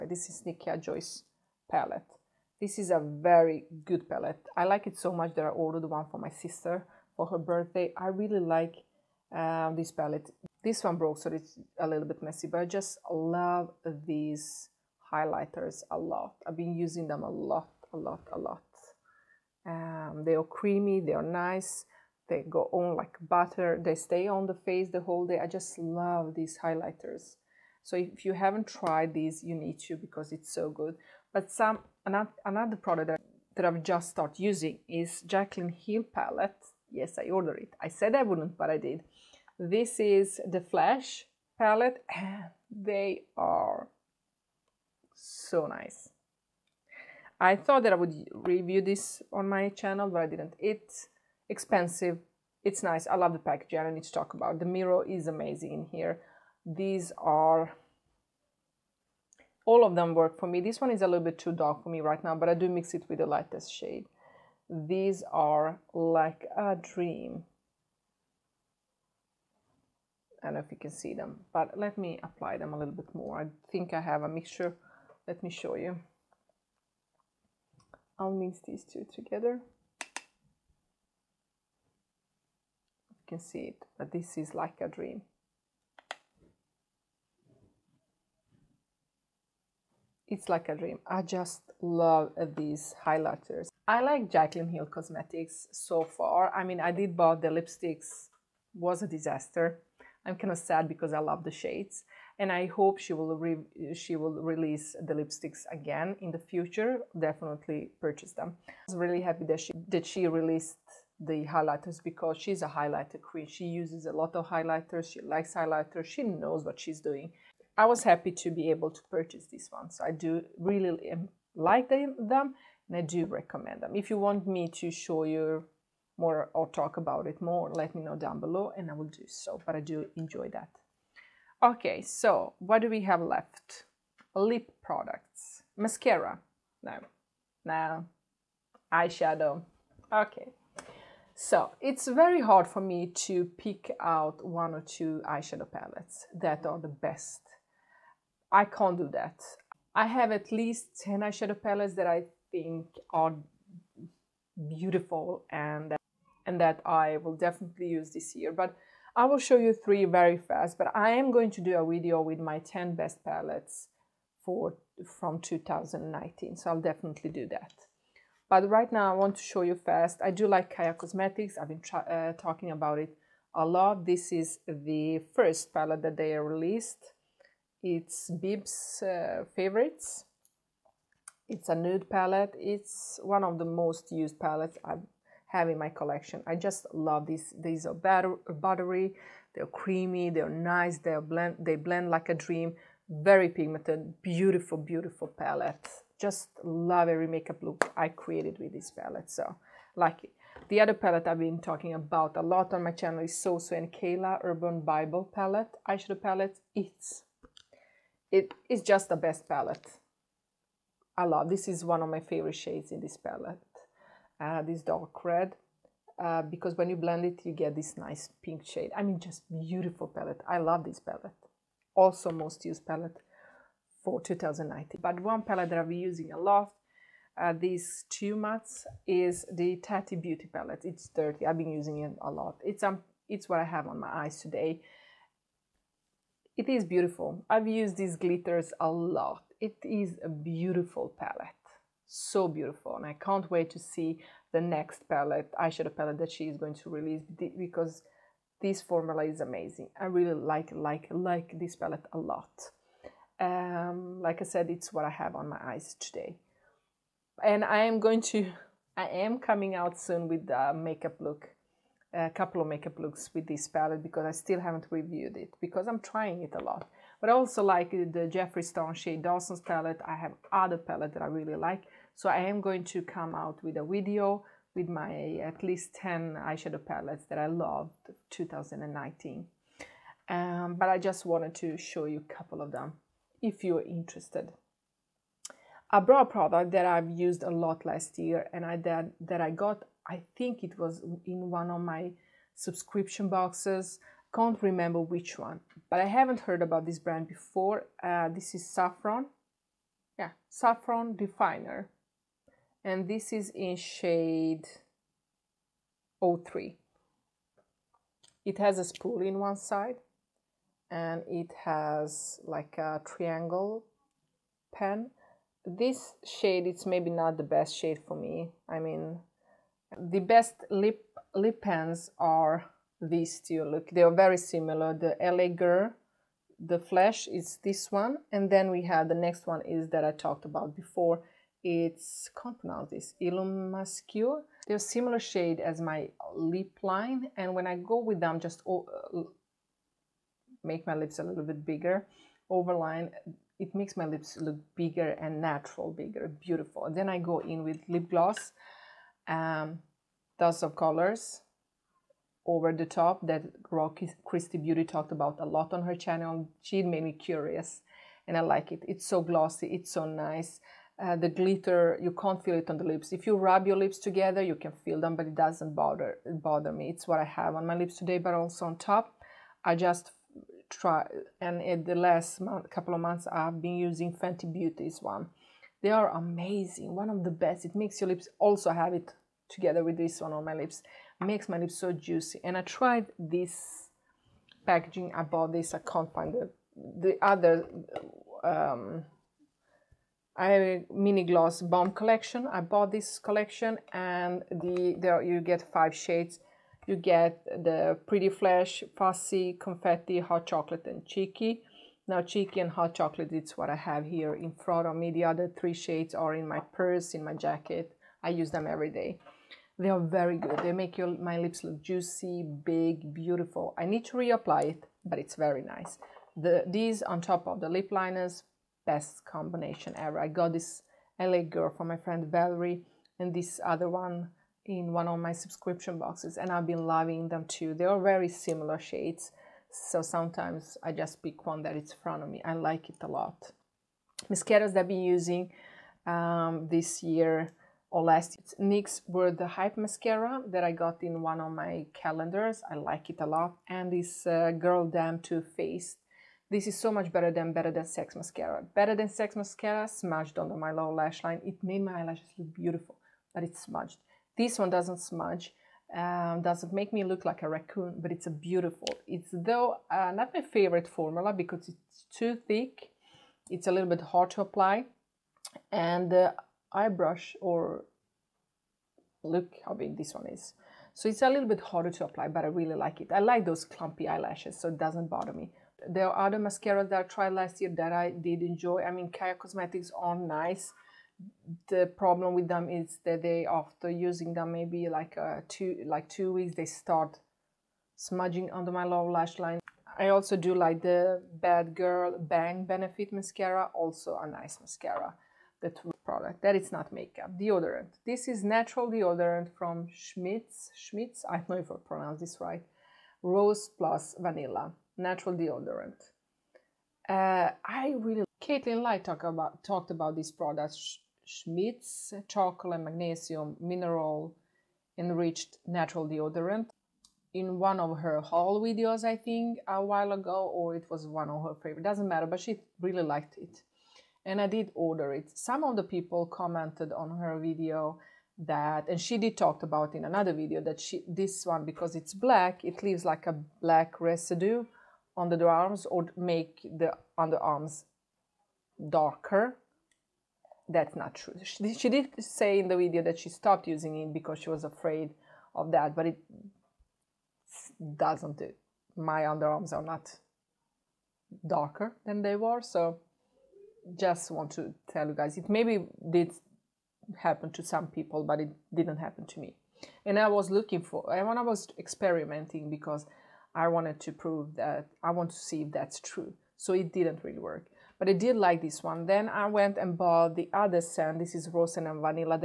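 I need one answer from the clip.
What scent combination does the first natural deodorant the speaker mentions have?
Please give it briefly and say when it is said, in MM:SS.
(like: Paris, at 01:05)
rose plus vanilla, at 08:23.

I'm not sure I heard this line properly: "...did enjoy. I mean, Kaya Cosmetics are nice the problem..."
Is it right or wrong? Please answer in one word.
right.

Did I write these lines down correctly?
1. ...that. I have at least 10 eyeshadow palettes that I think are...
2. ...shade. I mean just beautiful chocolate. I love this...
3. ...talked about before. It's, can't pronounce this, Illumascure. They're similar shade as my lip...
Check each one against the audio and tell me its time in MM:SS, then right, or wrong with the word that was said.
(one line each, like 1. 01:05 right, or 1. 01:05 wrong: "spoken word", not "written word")
1. 02:29 right
2. 03:38 wrong: "palette", not "chocolate"
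3. 05:30 right.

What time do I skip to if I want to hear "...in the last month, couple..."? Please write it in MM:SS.
06:11.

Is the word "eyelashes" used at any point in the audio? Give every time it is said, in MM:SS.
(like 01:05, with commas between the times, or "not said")
07:31, 07:54.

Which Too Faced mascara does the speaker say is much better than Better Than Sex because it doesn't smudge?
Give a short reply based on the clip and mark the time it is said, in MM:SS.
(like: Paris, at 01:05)
Girl Damn, at 07:24.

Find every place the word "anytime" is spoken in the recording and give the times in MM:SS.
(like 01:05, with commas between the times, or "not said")
not said.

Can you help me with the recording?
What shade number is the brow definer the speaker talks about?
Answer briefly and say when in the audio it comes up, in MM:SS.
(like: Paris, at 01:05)
03, at 05:06.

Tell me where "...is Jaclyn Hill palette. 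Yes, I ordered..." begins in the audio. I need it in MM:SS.
00:34.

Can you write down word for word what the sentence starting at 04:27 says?
But I also like the Jeffree Star Shane Dawson's palette.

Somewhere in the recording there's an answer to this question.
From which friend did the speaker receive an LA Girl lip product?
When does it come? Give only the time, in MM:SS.
07:02.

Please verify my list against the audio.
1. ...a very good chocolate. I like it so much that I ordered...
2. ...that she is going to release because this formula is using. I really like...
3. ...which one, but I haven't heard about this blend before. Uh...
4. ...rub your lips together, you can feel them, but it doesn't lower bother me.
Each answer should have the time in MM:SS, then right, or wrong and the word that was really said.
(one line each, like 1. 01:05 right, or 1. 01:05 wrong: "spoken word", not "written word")
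1. 00:02 wrong: "palette", not "chocolate"
2. 04:06 wrong: "amazing", not "using"
3. 04:54 wrong: "brand", not "blend"
4. 06:03 wrong: "bother", not "lower".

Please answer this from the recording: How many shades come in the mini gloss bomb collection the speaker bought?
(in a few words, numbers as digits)
five.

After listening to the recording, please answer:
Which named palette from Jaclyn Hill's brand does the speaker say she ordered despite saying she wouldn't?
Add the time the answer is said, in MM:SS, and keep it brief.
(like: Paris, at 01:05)
Flash palette, at 00:40.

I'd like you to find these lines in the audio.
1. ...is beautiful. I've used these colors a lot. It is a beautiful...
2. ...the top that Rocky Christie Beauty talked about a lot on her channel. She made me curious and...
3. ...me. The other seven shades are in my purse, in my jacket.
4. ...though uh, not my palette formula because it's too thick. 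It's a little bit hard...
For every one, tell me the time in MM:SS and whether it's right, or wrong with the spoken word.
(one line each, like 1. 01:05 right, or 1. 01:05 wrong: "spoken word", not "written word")
1. 03:56 wrong: "glitters", not "colors"
2. 05:52 right
3. 06:44 wrong: "three", not "seven"
4. 07:39 wrong: "favorite", not "palette".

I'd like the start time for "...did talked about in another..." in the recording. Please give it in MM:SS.
08:49.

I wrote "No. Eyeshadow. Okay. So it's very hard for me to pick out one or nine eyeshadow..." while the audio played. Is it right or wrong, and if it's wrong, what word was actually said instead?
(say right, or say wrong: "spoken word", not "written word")
wrong: "two", not "nine".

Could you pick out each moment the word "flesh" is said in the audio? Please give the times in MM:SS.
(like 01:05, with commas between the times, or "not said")
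05:26, 06:38.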